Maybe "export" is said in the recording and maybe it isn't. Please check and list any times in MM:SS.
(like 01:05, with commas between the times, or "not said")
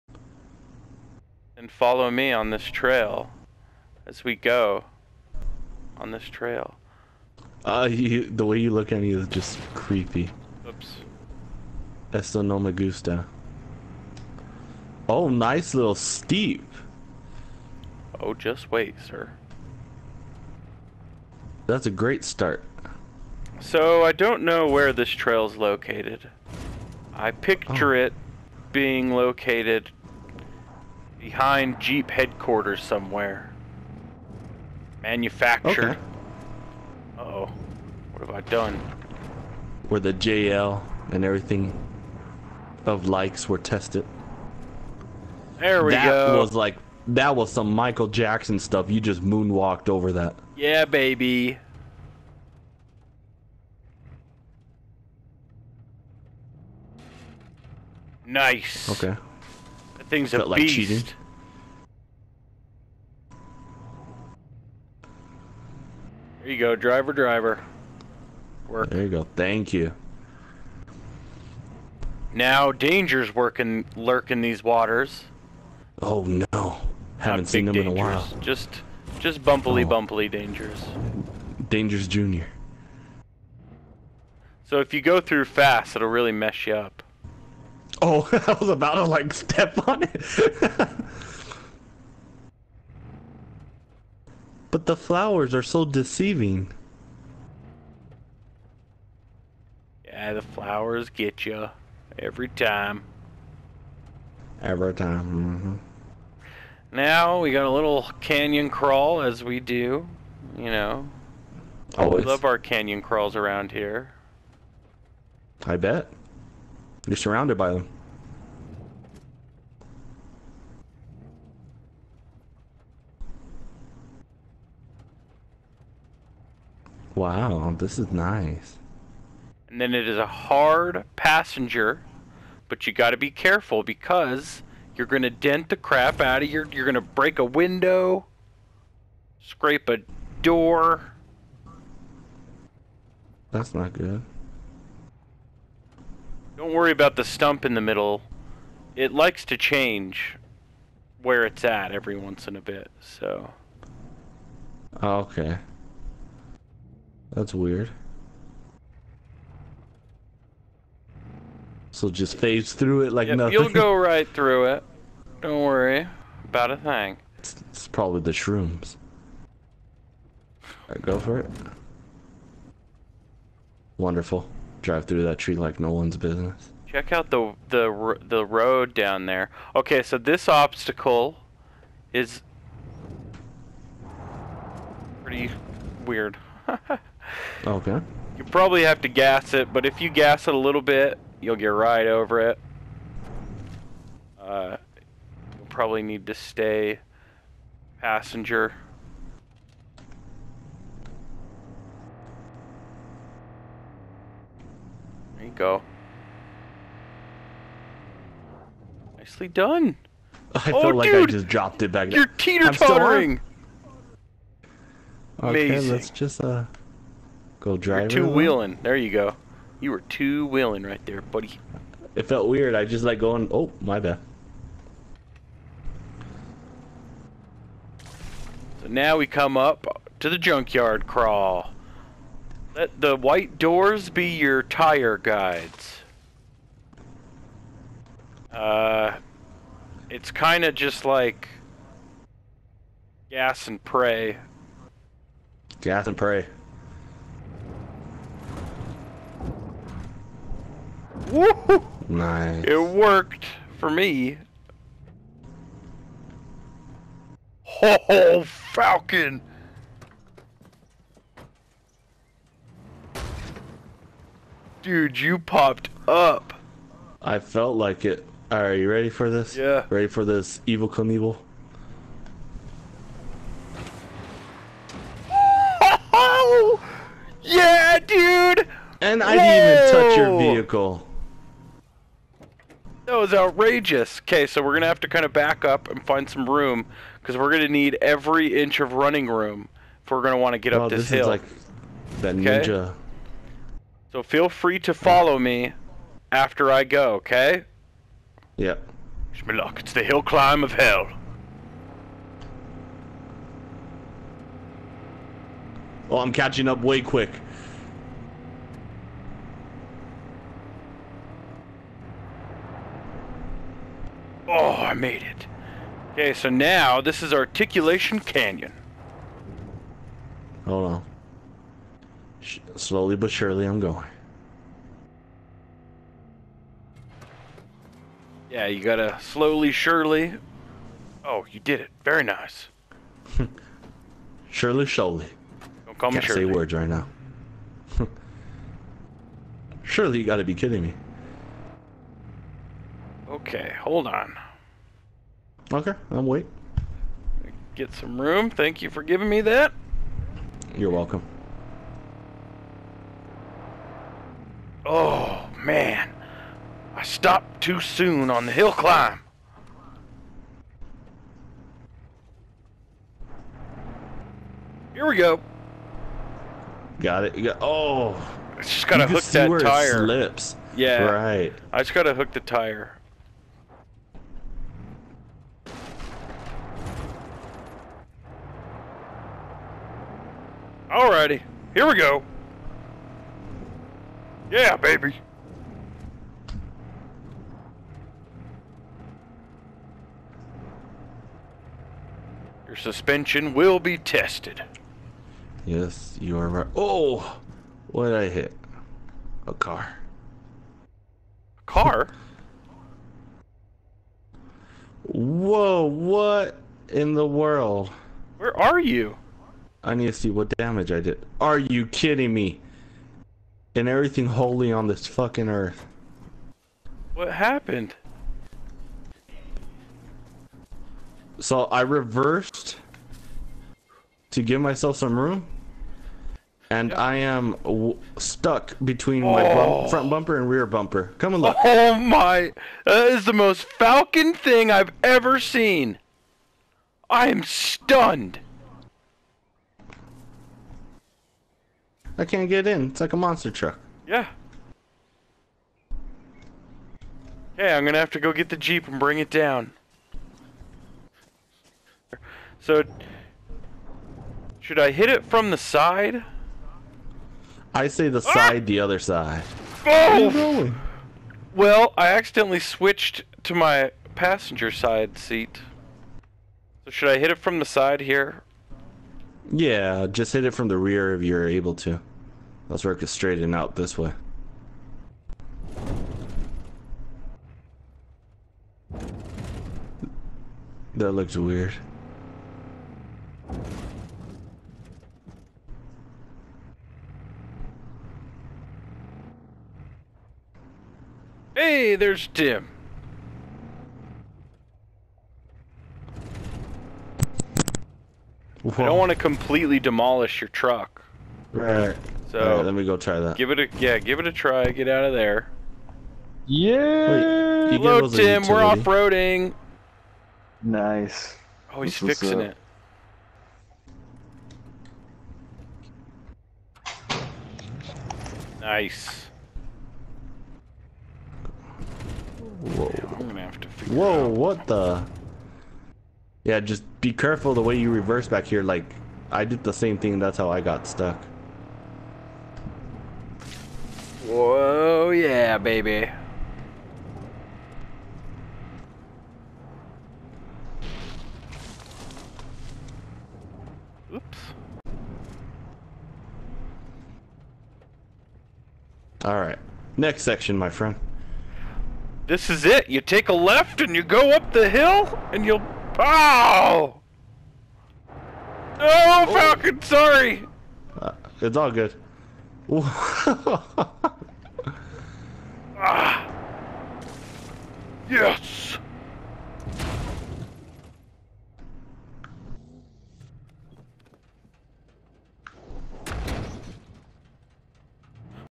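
not said.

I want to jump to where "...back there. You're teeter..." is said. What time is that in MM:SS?
03:31.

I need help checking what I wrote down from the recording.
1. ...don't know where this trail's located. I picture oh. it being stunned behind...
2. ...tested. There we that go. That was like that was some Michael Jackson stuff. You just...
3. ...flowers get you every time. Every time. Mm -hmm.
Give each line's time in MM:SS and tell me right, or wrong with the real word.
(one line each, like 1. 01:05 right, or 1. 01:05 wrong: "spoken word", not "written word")
1. 00:24 wrong: "located", not "stunned"
2. 00:43 right
3. 01:40 right.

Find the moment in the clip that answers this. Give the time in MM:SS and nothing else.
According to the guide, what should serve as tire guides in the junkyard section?
03:53.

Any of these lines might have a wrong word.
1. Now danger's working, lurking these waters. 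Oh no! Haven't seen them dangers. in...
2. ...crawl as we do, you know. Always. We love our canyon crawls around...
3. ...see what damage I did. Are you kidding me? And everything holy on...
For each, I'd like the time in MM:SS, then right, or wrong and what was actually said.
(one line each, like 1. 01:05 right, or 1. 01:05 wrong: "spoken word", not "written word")
1. 01:12 right
2. 01:48 right
3. 06:50 right.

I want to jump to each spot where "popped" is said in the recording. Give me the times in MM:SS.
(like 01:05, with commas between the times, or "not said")
04:25.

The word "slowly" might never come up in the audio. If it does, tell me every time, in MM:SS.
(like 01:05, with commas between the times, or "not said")
05:22, 05:29.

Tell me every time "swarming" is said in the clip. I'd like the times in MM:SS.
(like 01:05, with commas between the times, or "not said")
not said.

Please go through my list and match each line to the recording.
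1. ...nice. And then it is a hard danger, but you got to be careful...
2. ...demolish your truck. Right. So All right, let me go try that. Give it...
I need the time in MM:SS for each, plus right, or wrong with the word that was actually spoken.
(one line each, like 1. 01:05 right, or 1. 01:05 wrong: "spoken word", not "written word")
1. 02:08 wrong: "passenger", not "danger"
2. 08:19 right.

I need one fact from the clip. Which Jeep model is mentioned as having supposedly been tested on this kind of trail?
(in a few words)
JL.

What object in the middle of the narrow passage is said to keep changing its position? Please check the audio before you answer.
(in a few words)
The stump.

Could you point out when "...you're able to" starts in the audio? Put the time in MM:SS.
07:51.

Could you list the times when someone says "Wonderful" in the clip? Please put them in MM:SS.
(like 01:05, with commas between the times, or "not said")
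02:53.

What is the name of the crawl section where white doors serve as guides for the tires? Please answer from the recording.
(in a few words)
Junkyard crawl.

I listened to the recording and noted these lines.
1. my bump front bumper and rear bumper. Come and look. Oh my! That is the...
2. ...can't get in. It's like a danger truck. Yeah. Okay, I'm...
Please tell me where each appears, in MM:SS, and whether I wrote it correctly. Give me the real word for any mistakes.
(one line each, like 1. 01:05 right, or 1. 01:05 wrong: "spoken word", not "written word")
1. 07:09 right
2. 07:22 wrong: "monster", not "danger".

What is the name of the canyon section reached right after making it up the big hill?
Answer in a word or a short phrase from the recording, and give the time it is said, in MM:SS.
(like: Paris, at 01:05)
Articulation Canyon, at 05:17.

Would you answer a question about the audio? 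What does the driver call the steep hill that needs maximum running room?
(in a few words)
Hill climb of hell.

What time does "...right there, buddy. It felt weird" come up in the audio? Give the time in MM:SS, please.
03:40.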